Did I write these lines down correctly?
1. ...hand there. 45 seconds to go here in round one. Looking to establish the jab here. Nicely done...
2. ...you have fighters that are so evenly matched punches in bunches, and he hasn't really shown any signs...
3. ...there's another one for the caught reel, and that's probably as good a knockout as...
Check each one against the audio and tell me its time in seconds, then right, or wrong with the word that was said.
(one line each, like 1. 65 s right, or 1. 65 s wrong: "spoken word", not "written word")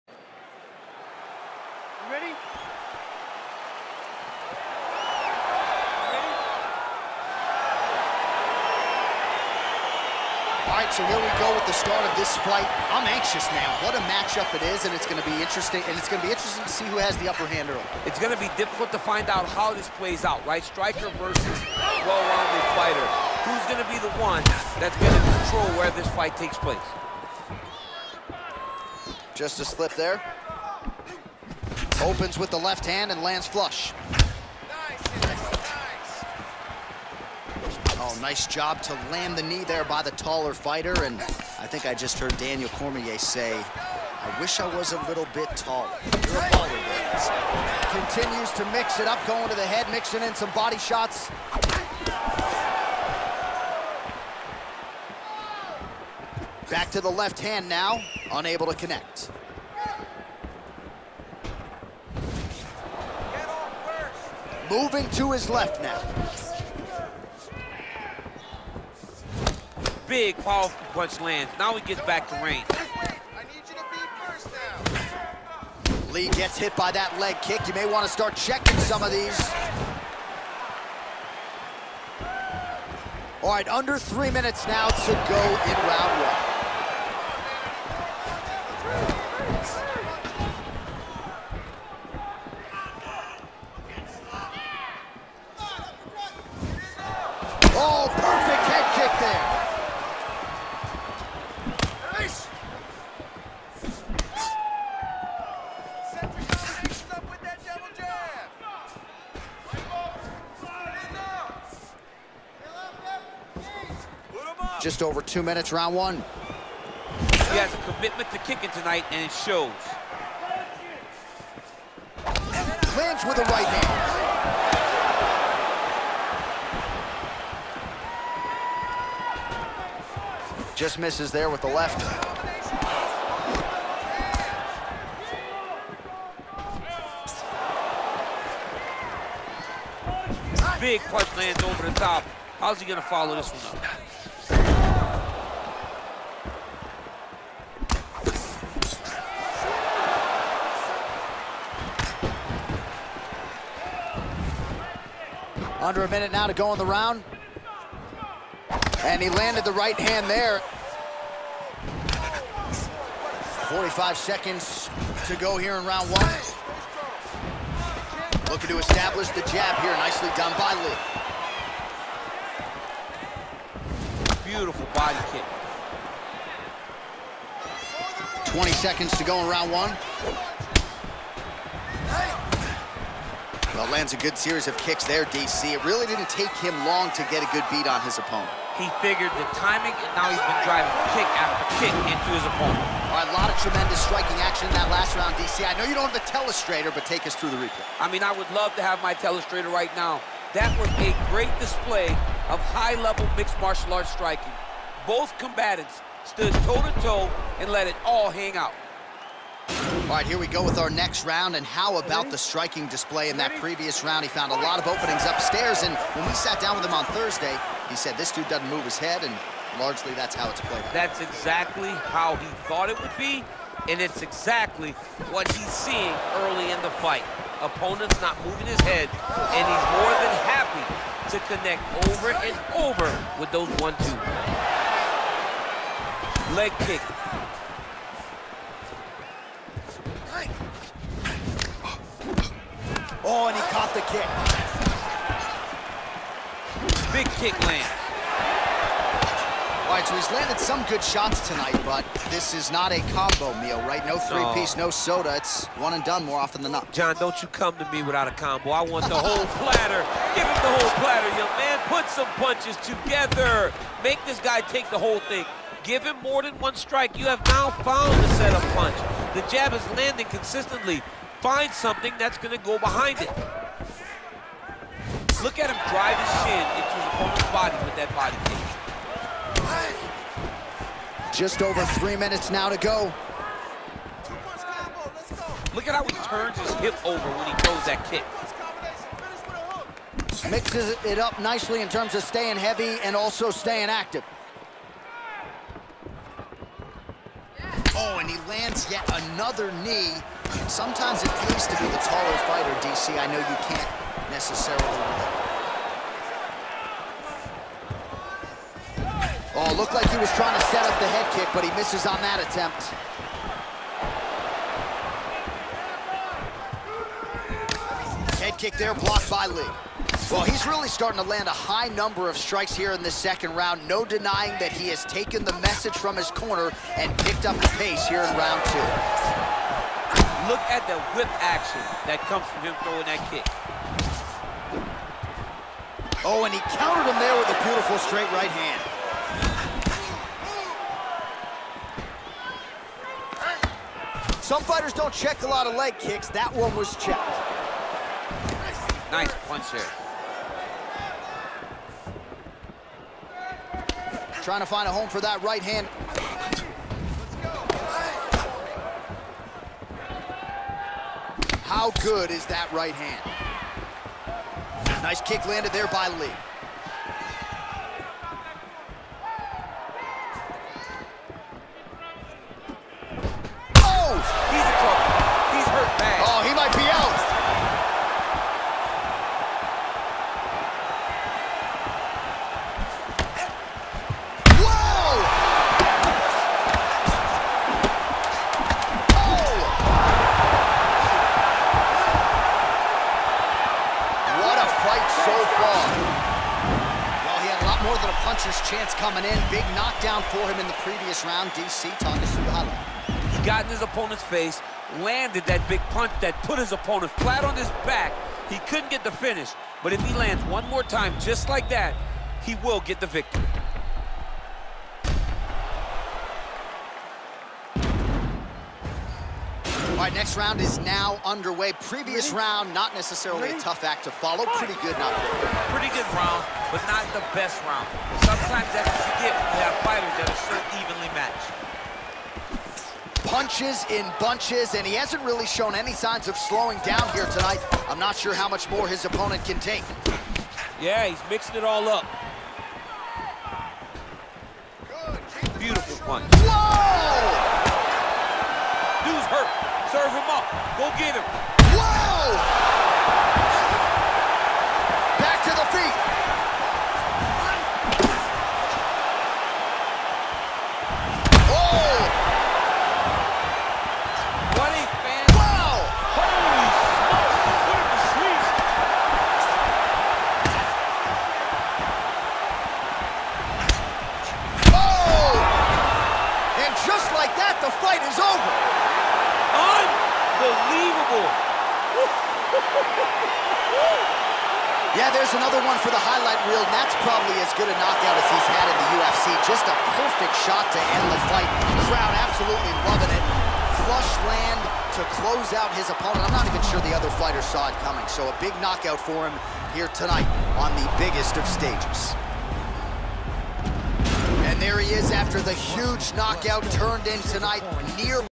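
1. 159 s right
2. 429 s right
3. 485 s wrong: "highlight", not "caught".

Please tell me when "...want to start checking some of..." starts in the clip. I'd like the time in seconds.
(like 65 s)
77 s.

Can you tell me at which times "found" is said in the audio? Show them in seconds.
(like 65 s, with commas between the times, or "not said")
214 s, 267 s.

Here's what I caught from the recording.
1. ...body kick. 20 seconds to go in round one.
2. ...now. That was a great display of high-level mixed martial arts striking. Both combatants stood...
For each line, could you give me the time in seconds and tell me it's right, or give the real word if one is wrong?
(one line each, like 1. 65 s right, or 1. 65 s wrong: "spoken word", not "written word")
1. 174 s right
2. 199 s right.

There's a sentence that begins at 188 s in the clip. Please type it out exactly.
He figured the timing, and now he's been driving kick after kick into his opponent.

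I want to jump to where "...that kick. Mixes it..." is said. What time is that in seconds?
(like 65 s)
287 s.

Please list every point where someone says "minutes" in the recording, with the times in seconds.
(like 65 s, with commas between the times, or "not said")
84 s, 115 s, 156 s, 282 s.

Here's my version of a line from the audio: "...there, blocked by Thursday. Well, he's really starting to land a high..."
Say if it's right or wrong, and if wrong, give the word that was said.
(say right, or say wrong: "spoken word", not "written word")
wrong: "Lee", not "Thursday".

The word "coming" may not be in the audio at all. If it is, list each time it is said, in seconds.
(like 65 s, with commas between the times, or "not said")
398 s, 497 s.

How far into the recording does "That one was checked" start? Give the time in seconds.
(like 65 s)
346 s.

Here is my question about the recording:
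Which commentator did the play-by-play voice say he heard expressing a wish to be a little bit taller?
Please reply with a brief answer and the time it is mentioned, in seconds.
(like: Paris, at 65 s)
Daniel Cormier, at 42 s.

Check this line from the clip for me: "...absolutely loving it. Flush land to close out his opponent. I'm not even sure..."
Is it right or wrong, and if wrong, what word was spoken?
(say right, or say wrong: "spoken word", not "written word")
right.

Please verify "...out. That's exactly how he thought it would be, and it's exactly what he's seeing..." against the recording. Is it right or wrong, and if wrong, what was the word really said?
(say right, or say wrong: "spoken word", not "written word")
right.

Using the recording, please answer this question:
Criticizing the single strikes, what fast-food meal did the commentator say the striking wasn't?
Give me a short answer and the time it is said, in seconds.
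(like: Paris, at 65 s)
A combo meal, at 253 s.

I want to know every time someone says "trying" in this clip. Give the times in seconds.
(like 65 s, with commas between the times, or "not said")
310 s, 354 s.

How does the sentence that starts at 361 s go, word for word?
How good is that right hand?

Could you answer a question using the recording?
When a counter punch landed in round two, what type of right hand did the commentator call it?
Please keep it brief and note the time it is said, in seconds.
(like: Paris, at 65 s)
Straight right hand, at 337 s.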